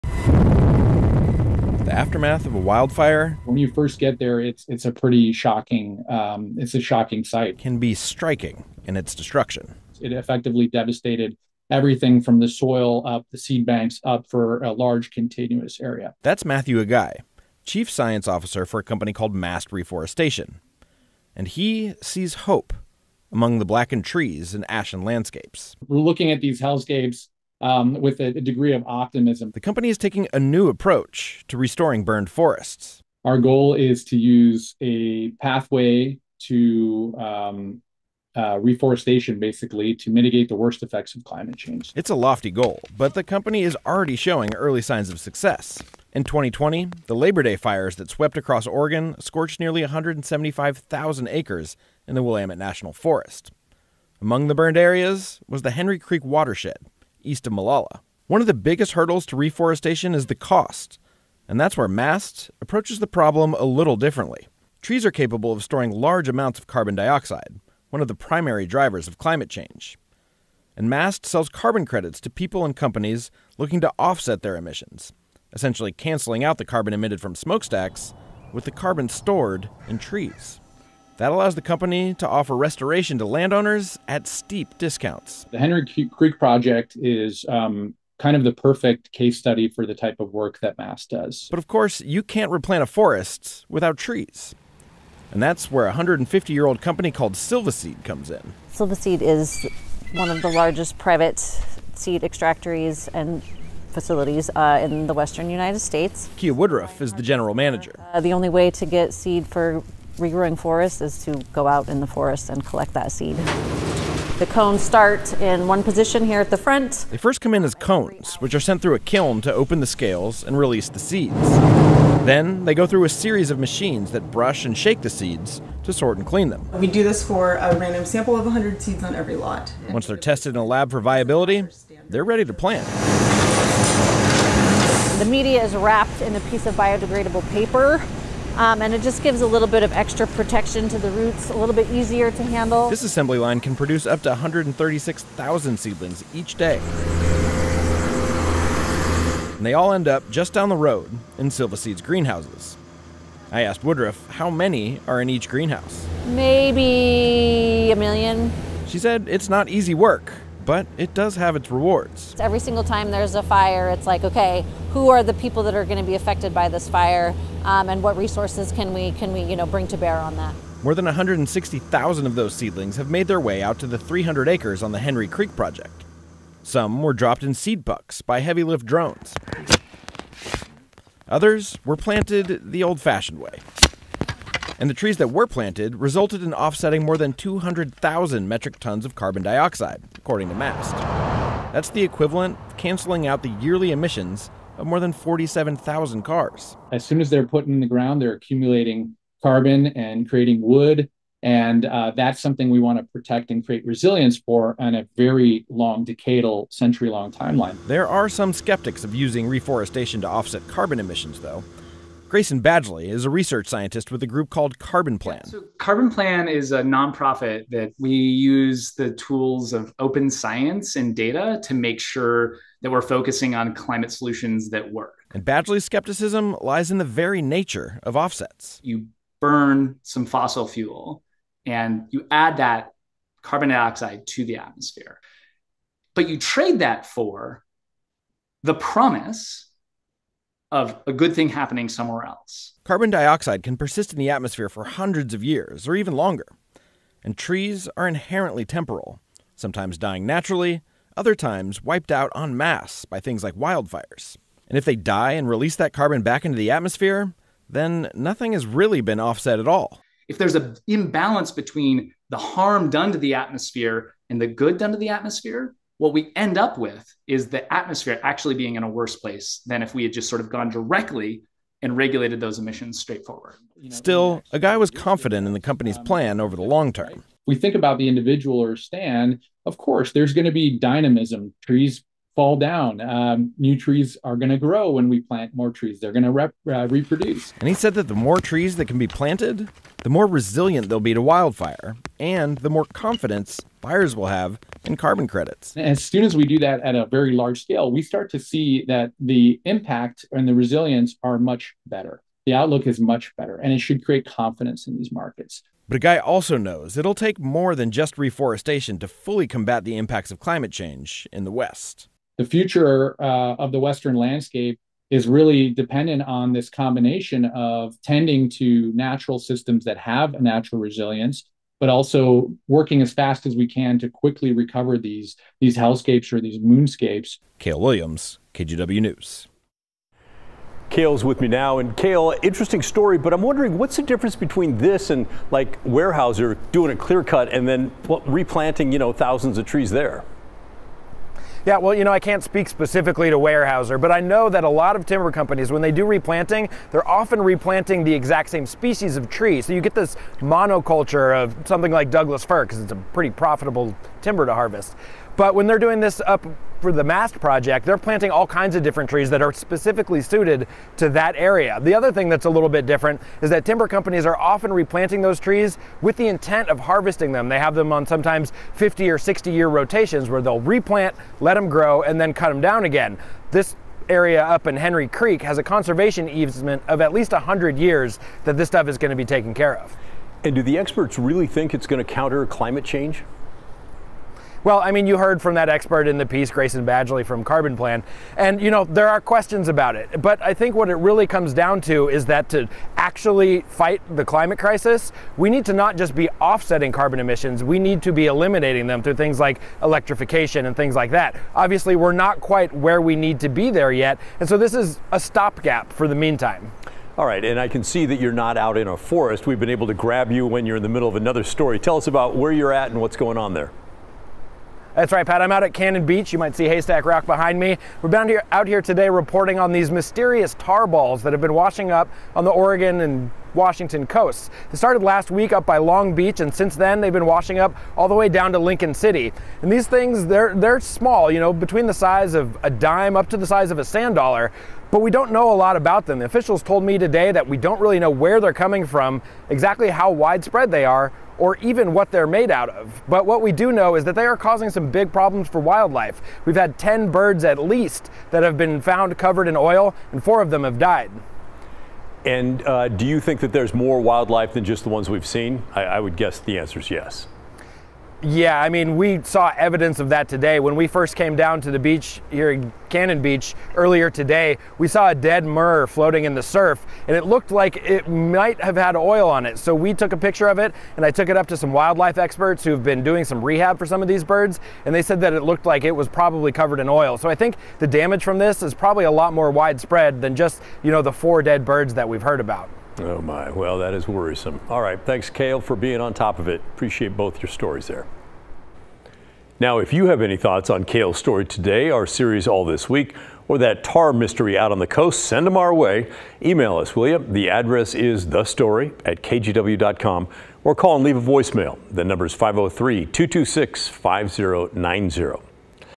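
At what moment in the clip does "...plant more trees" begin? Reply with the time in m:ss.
4:45.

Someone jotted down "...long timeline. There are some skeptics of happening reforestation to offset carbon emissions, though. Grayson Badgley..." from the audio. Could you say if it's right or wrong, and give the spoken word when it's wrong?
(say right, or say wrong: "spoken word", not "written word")
wrong: "using", not "happening".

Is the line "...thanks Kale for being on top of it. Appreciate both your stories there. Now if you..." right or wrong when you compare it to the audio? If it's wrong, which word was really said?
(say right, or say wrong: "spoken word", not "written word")
right.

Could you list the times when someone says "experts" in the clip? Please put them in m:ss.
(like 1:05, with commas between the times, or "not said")
6:20, 6:25, 7:52.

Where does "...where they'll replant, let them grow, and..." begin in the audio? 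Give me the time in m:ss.
6:10.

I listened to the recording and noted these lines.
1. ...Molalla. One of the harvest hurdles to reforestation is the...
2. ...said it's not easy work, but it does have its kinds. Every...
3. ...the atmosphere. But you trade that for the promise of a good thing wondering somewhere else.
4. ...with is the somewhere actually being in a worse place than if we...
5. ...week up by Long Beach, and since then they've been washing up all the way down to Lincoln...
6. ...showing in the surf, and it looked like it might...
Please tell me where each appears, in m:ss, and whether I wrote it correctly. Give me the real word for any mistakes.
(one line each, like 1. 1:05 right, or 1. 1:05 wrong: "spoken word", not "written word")
1. 0:57 wrong: "biggest", not "harvest"
2. 2:38 wrong: "rewards", not "kinds"
3. 3:54 wrong: "happening", not "wondering"
4. 4:26 wrong: "atmosphere", not "somewhere"
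5. 7:05 right
6. 7:45 wrong: "floating", not "showing".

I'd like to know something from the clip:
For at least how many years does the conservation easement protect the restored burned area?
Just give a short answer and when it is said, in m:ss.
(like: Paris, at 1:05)
100, at 6:16.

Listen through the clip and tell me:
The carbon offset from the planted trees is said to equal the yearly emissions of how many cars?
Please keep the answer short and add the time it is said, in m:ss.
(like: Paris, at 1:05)
47,000, at 3:14.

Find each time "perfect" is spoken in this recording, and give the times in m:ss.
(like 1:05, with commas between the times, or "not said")
1:28.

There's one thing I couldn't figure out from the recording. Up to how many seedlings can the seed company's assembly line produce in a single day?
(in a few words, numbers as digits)
136,000.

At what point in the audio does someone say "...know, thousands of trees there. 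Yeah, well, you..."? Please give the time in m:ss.
5:38.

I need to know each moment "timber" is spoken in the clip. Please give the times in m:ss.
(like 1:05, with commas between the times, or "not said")
5:45, 5:54, 6:03.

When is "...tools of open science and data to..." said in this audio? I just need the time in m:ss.
3:39.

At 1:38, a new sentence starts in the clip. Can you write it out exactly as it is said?
Silvaseed is one of the largest private seed extractories and facilities uh, in the western United States.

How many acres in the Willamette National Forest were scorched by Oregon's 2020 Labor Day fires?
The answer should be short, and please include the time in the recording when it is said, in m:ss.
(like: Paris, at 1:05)
175,000, at 0:49.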